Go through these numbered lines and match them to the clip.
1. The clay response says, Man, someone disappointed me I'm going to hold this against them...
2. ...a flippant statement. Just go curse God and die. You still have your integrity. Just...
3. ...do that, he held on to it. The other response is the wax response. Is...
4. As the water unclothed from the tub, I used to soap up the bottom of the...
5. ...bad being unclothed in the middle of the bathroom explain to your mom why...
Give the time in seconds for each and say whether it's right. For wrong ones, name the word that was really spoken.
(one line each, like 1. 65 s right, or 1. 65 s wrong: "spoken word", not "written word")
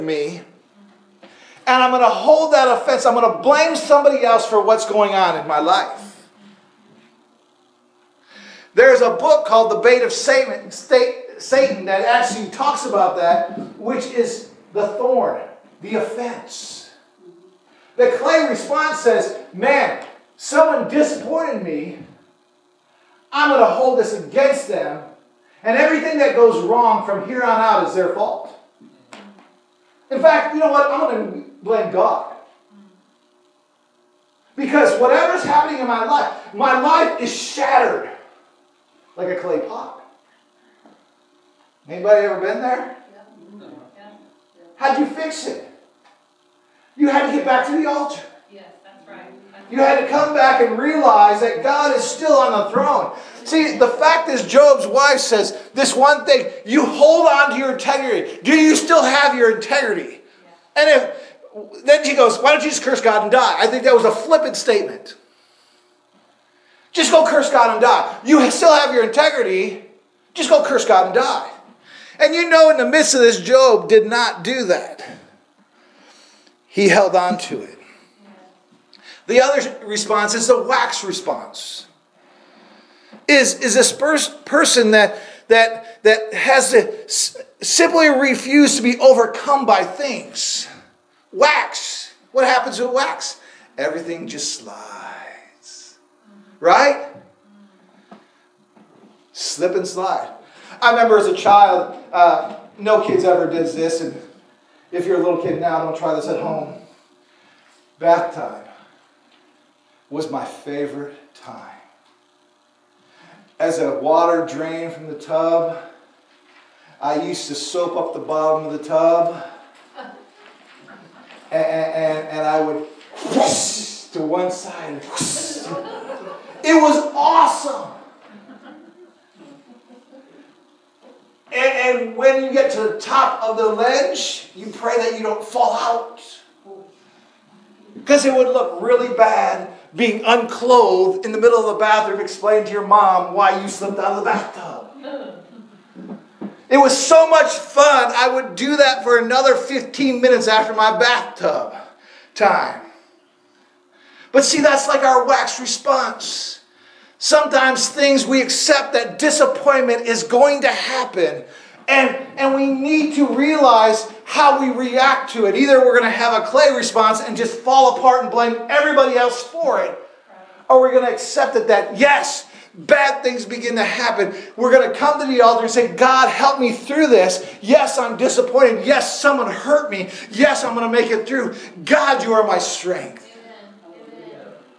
1. 17 s right
2. 64 s right
3. 74 s right
4. 113 s wrong: "drained", not "unclothed"
5. 139 s right.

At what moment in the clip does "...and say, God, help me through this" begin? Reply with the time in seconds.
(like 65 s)
175 s.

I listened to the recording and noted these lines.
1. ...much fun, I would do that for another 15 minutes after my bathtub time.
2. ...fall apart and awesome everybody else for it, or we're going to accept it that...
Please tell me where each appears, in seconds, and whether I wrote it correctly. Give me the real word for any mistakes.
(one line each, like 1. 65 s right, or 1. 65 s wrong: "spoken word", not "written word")
1. 147 s right
2. 167 s wrong: "blame", not "awesome".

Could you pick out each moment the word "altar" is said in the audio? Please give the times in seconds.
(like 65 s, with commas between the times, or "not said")
47 s, 175 s.